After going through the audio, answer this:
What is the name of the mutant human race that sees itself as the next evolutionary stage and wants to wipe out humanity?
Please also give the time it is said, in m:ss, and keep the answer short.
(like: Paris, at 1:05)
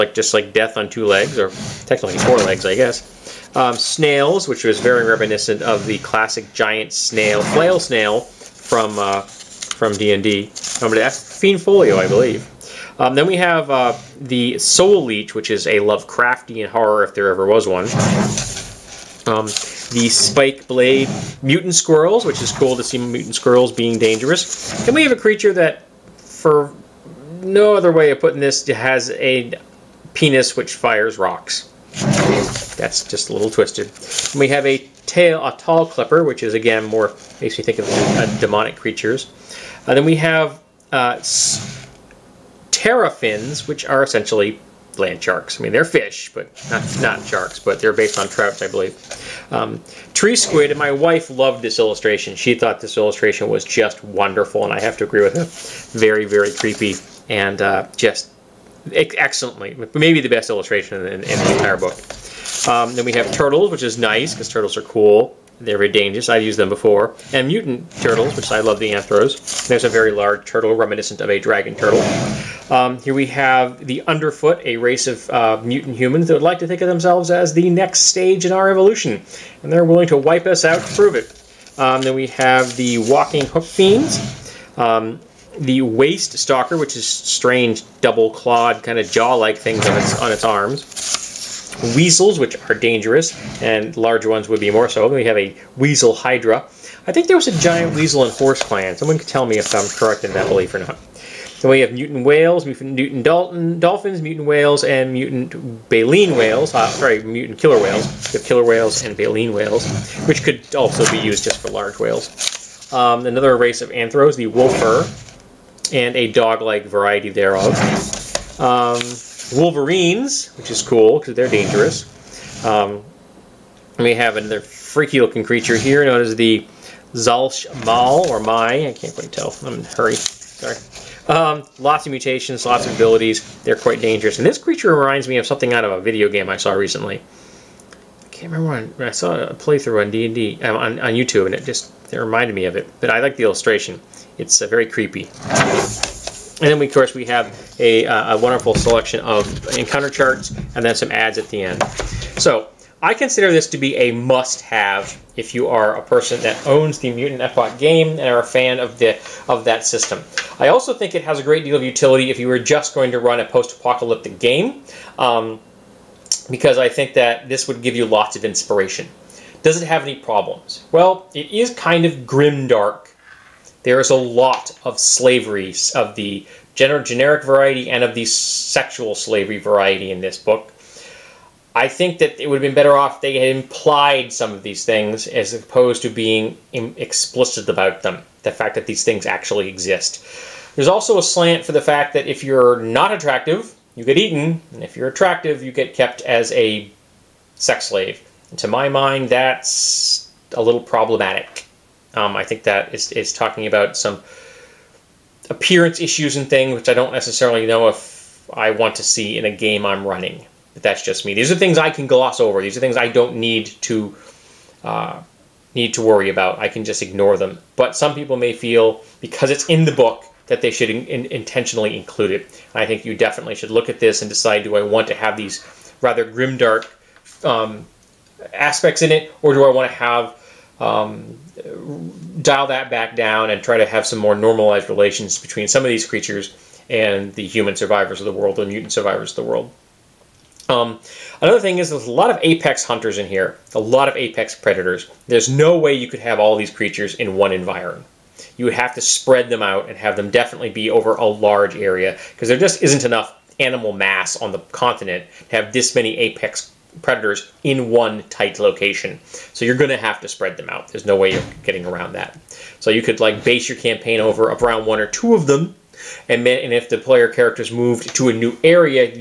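The Underfoot, at 1:13.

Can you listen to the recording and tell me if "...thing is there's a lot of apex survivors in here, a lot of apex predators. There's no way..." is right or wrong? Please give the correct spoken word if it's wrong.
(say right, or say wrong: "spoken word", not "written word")
wrong: "hunters", not "survivors".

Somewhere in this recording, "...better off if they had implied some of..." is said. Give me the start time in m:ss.
3:02.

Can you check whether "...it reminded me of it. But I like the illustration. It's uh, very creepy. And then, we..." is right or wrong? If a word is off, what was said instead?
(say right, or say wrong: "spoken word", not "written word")
right.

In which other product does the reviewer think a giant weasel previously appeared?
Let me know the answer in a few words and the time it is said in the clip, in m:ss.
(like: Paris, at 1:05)
Horse Clan, at 1:38.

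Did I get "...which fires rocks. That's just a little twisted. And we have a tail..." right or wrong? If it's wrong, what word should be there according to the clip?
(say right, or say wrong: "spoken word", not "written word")
right.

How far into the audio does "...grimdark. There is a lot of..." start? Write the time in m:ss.
2:52.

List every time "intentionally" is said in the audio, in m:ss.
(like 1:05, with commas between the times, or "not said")
3:41.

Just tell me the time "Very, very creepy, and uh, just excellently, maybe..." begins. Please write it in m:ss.
0:55.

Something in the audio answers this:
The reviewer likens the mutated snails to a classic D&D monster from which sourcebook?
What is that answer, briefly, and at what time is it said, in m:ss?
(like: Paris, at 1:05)
Fiend Folio, at 0:11.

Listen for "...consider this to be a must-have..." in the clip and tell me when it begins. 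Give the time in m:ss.
2:33.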